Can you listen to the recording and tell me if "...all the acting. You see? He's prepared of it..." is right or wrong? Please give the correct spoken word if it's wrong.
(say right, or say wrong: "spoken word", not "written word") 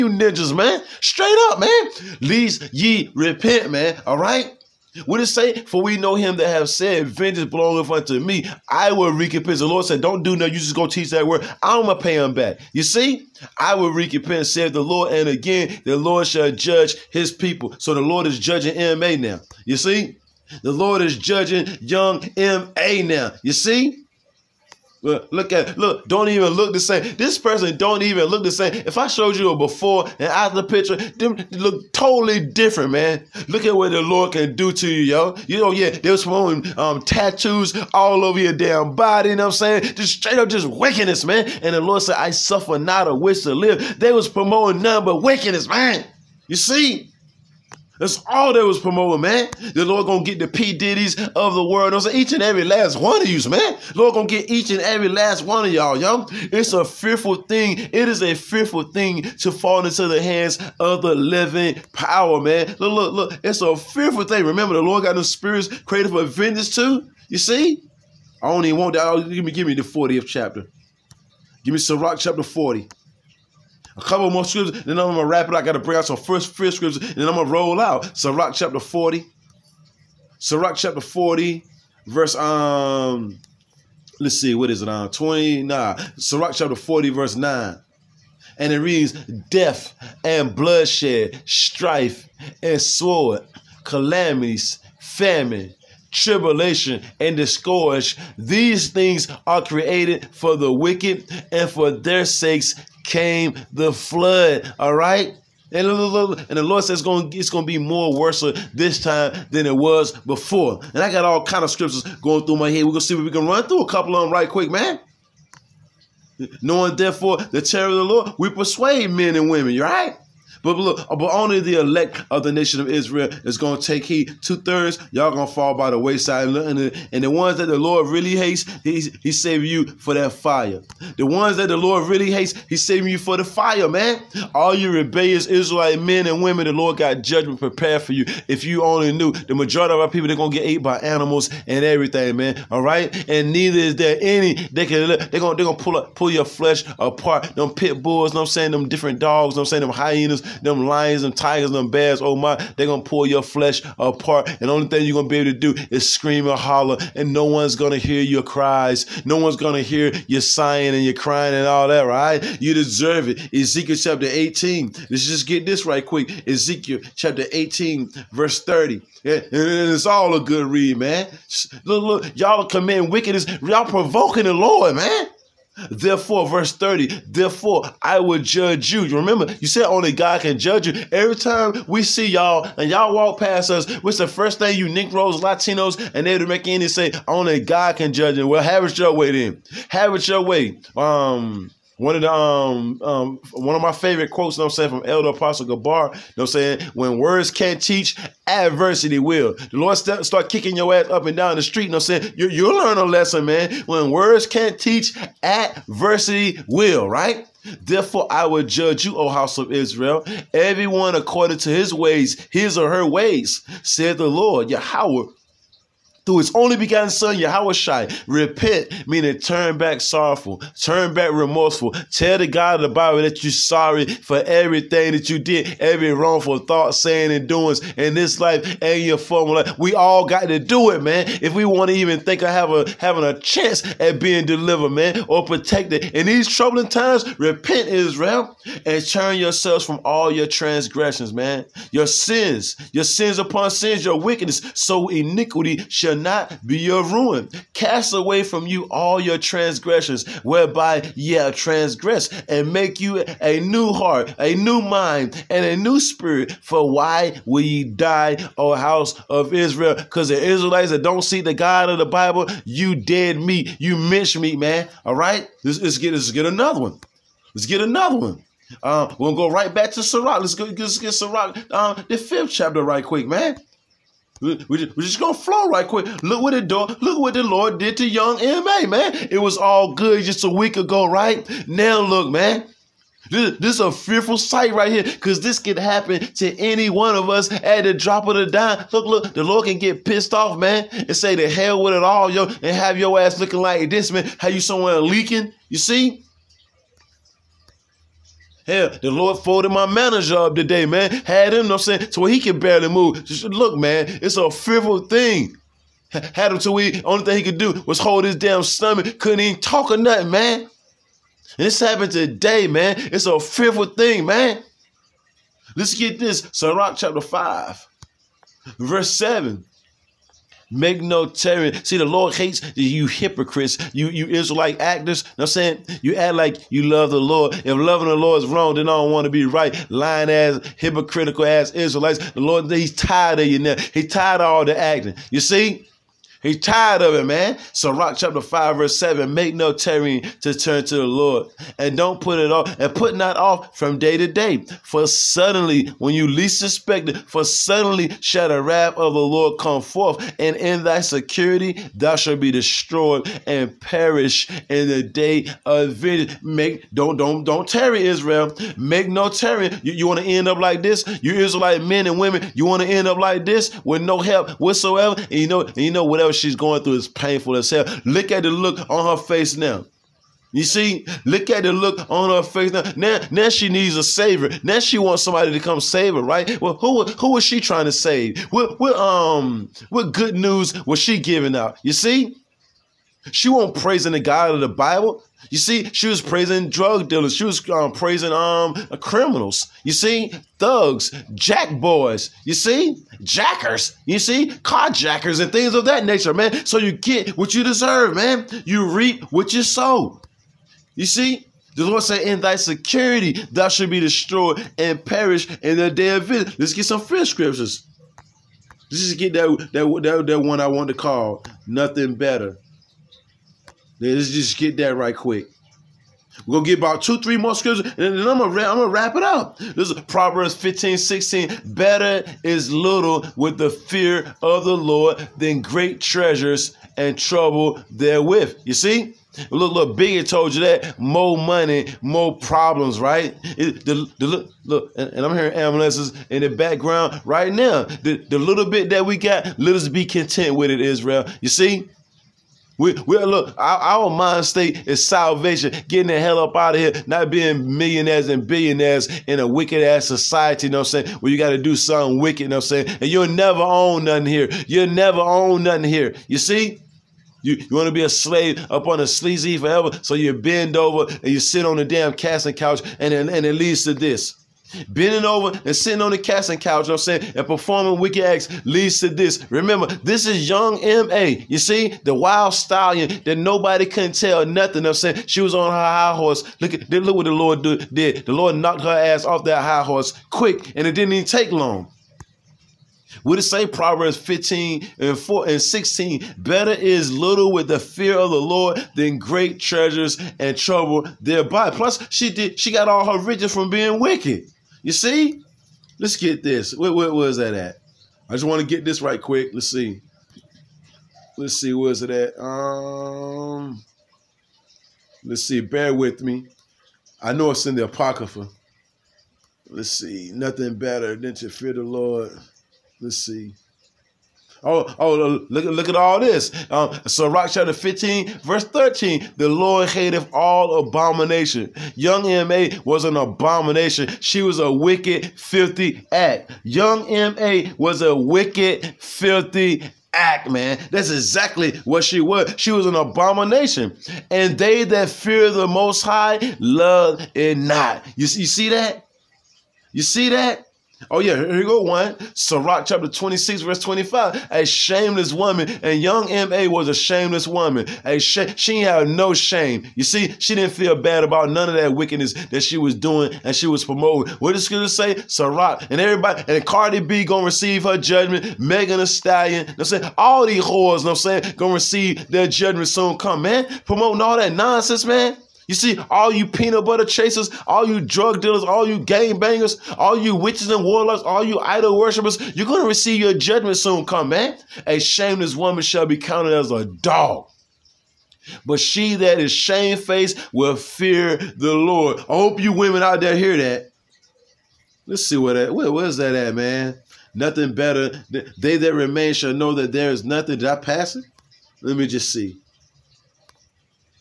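wrong: "tired", not "prepared".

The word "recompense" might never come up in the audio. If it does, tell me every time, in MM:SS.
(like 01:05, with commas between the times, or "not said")
00:09, 00:13.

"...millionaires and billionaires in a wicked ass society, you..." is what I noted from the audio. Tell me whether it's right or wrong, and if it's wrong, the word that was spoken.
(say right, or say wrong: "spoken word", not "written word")
right.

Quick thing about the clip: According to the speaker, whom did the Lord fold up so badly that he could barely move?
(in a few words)
My manager.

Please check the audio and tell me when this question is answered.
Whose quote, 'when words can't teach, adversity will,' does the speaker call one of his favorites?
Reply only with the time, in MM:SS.
03:15.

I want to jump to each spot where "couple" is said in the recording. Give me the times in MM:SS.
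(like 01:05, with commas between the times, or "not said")
01:14, 01:53.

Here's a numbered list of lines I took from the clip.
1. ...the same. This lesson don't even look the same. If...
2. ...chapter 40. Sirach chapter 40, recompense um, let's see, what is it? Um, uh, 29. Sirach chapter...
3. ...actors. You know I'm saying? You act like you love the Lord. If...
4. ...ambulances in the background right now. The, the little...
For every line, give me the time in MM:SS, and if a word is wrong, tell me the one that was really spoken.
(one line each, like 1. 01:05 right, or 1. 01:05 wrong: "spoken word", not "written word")
1. 00:26 wrong: "person", not "lesson"
2. 01:18 wrong: "verse", not "recompense"
3. 05:24 right
4. 07:15 right.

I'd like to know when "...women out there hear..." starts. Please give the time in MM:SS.
09:42.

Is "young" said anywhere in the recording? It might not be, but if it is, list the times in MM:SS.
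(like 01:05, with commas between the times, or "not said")
00:21, 04:38, 07:50, 08:41, 08:46, 09:06.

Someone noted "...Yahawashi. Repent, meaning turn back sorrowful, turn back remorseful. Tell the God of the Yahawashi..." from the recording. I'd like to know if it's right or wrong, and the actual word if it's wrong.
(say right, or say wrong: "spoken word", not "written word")
wrong: "Bible", not "Yahawashi".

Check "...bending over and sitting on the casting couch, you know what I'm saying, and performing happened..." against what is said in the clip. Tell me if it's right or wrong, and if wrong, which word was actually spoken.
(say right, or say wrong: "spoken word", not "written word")
wrong: "wicked", not "happened".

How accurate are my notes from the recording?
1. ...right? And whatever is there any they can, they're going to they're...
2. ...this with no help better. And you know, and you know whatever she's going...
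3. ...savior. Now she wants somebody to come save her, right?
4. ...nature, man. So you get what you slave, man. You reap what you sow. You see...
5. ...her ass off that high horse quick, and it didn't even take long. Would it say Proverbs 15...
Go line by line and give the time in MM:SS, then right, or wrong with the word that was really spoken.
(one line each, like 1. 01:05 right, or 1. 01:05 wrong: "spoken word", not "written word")
1. 02:22 wrong: "neither", not "whatever"
2. 06:03 wrong: "whatsoever", not "better"
3. 06:14 right
4. 06:36 wrong: "deserve", not "slave"
5. 07:58 right.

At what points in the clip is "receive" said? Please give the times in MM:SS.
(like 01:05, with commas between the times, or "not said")
09:17, 09:21, 09:32.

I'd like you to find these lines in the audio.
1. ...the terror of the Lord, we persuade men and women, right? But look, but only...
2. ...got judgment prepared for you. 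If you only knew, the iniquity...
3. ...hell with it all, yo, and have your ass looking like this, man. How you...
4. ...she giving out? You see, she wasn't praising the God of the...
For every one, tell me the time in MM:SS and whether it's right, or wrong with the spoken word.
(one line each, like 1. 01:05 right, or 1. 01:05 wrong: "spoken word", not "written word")
1. 01:57 right
2. 02:16 wrong: "majority", not "iniquity"
3. 04:51 right
4. 06:21 right.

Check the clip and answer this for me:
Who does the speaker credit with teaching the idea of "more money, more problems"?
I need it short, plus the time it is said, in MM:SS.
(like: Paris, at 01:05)
Biggie, at 07:09.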